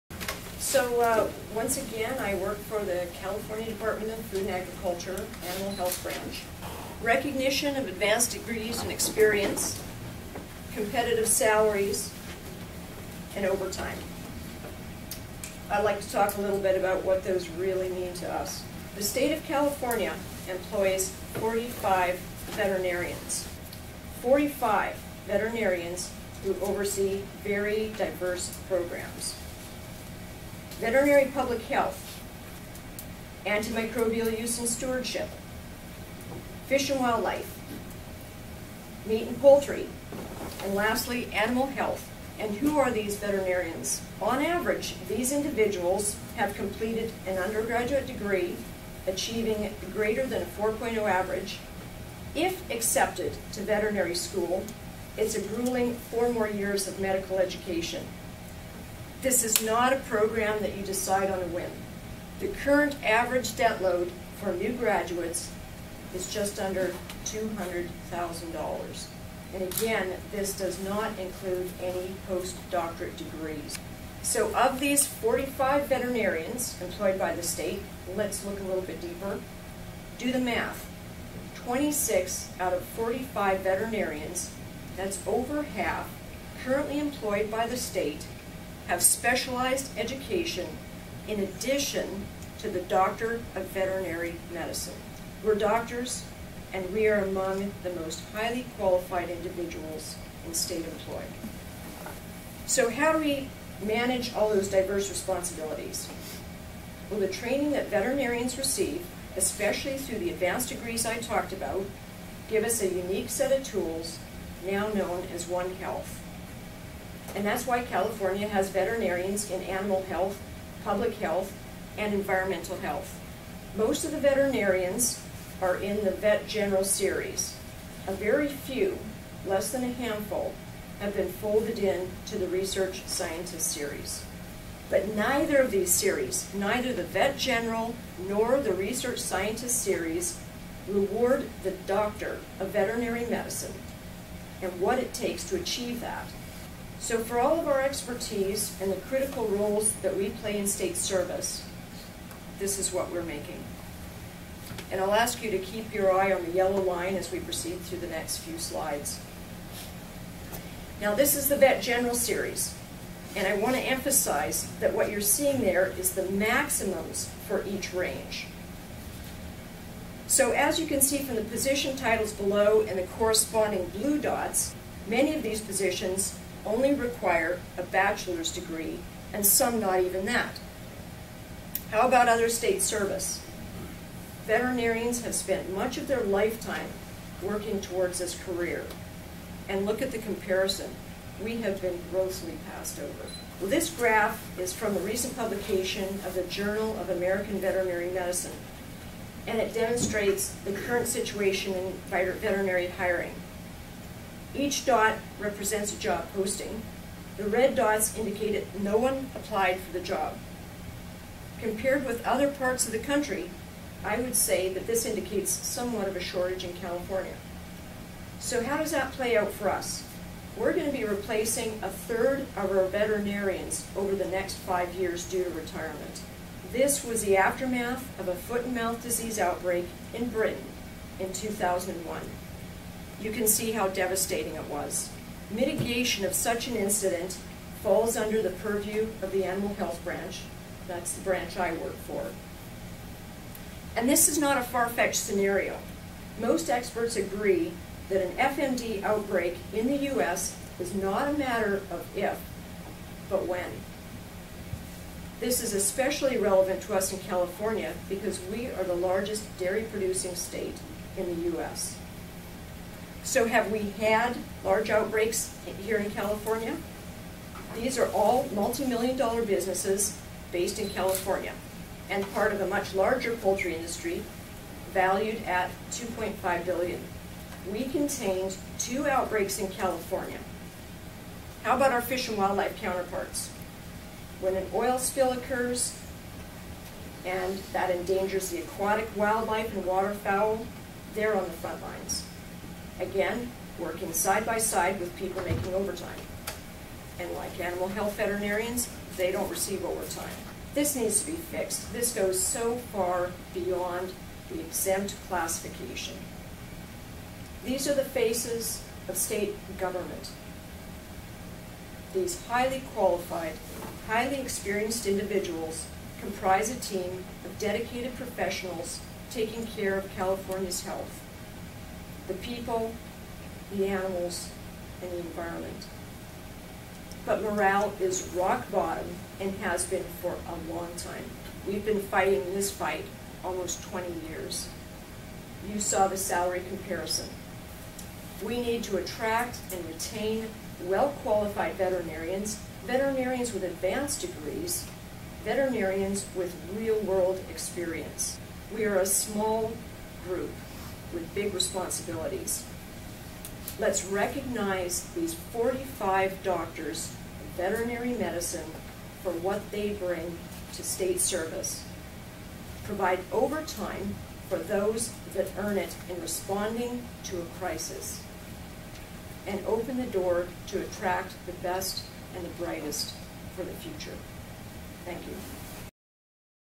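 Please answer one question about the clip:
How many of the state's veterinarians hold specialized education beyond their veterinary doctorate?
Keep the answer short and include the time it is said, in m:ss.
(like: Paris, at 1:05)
26, at 1:21.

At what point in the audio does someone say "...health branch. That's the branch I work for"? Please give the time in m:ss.
3:59.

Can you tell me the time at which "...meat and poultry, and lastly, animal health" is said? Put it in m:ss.
0:39.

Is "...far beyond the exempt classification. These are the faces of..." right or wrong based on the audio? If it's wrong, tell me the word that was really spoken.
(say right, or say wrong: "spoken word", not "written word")
right.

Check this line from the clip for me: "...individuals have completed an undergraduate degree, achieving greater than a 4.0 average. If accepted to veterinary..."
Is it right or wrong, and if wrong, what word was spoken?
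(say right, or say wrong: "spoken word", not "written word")
right.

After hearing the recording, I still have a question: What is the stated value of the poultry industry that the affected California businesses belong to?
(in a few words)
2.5 billion.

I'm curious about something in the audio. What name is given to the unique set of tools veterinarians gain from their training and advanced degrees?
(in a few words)
One Health.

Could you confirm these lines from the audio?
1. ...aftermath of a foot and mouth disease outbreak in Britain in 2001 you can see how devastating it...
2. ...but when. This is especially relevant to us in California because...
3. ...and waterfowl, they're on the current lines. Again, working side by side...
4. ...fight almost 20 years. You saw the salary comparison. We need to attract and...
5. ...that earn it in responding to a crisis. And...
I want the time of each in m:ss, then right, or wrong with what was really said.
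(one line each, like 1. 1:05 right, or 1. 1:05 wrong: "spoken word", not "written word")
1. 3:47 right
2. 4:13 right
3. 4:49 wrong: "front", not "current"
4. 5:32 right
5. 6:05 right.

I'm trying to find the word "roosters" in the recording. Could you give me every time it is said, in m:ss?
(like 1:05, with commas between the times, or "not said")
not said.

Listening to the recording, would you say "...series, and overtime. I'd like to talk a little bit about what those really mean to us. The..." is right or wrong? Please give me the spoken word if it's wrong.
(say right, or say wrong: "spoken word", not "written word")
wrong: "salaries", not "series".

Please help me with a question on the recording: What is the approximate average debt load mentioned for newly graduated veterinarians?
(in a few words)
Just under $200,000.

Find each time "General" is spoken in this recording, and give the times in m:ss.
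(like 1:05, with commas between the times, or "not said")
2:06, 2:17, 2:41.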